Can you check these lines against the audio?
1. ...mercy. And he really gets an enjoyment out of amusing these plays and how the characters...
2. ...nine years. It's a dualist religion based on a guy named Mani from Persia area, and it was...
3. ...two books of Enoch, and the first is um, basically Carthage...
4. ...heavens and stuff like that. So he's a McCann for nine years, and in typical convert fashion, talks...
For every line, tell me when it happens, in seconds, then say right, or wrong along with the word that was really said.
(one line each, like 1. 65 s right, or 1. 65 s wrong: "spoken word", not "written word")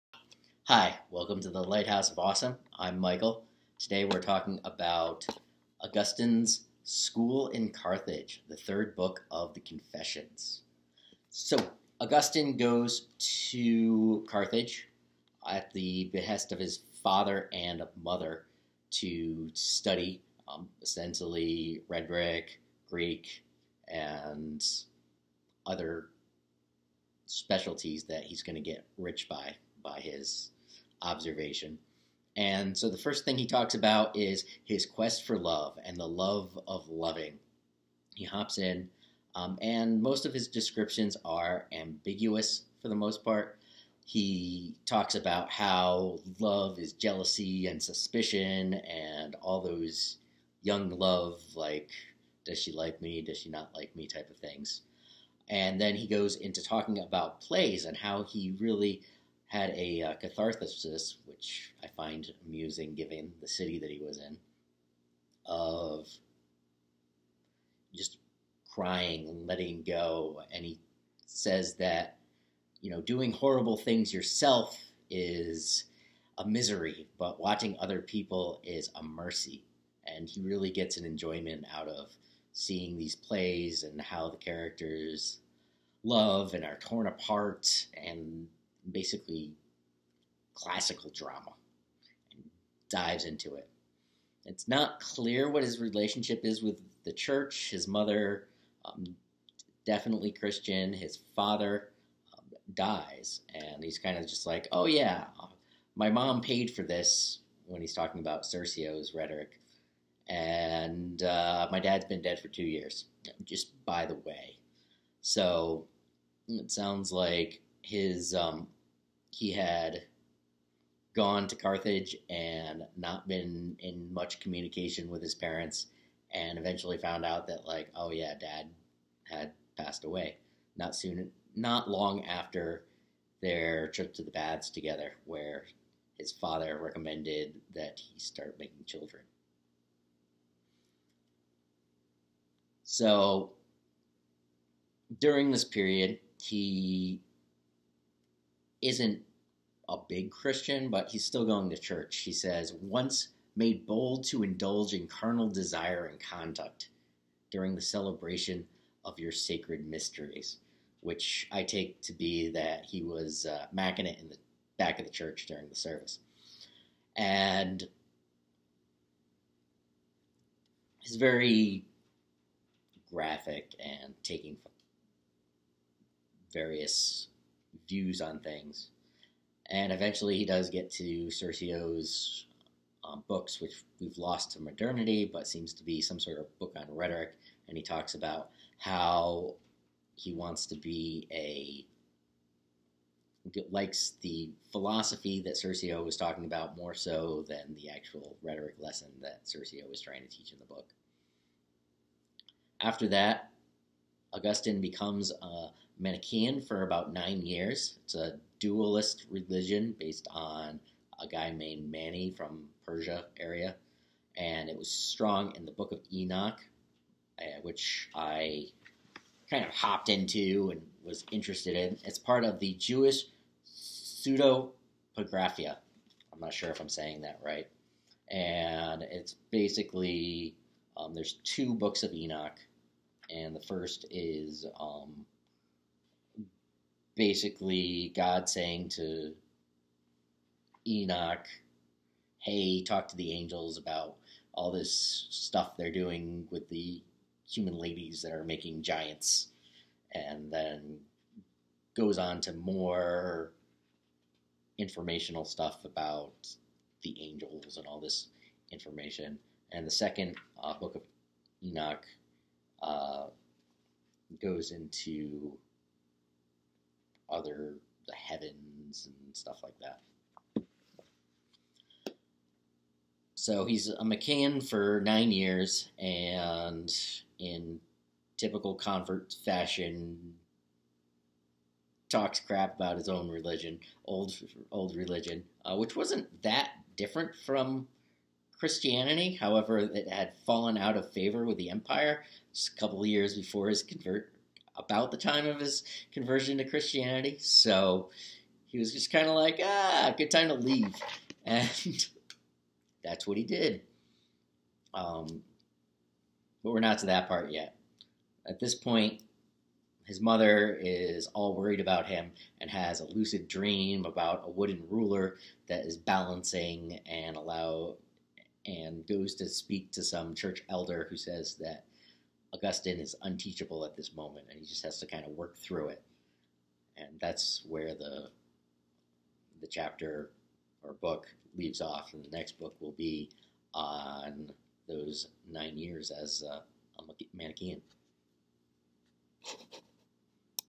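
1. 79 s wrong: "seeing", not "amusing"
2. 207 s right
3. 231 s wrong: "God", not "Carthage"
4. 268 s right.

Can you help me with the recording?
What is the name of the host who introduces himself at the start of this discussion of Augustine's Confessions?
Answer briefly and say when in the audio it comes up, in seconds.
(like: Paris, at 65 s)
Michael, at 2 s.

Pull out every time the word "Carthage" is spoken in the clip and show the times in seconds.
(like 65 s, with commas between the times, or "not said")
7 s, 14 s, 121 s.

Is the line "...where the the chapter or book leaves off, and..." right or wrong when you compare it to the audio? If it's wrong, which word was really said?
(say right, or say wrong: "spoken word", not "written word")
right.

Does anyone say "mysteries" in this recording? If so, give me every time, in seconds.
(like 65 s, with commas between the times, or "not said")
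159 s.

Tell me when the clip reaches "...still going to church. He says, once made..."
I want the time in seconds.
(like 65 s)
151 s.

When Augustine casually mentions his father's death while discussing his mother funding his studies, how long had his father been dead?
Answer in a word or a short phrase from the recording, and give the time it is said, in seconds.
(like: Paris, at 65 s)
2 years, at 112 s.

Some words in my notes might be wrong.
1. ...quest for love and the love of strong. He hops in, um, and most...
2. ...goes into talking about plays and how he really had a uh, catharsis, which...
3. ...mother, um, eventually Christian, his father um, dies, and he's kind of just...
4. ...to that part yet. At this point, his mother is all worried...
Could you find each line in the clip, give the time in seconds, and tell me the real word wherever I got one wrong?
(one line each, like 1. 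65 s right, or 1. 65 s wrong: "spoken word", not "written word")
1. 34 s wrong: "loving", not "strong"
2. 56 s right
3. 97 s wrong: "definitely", not "eventually"
4. 306 s right.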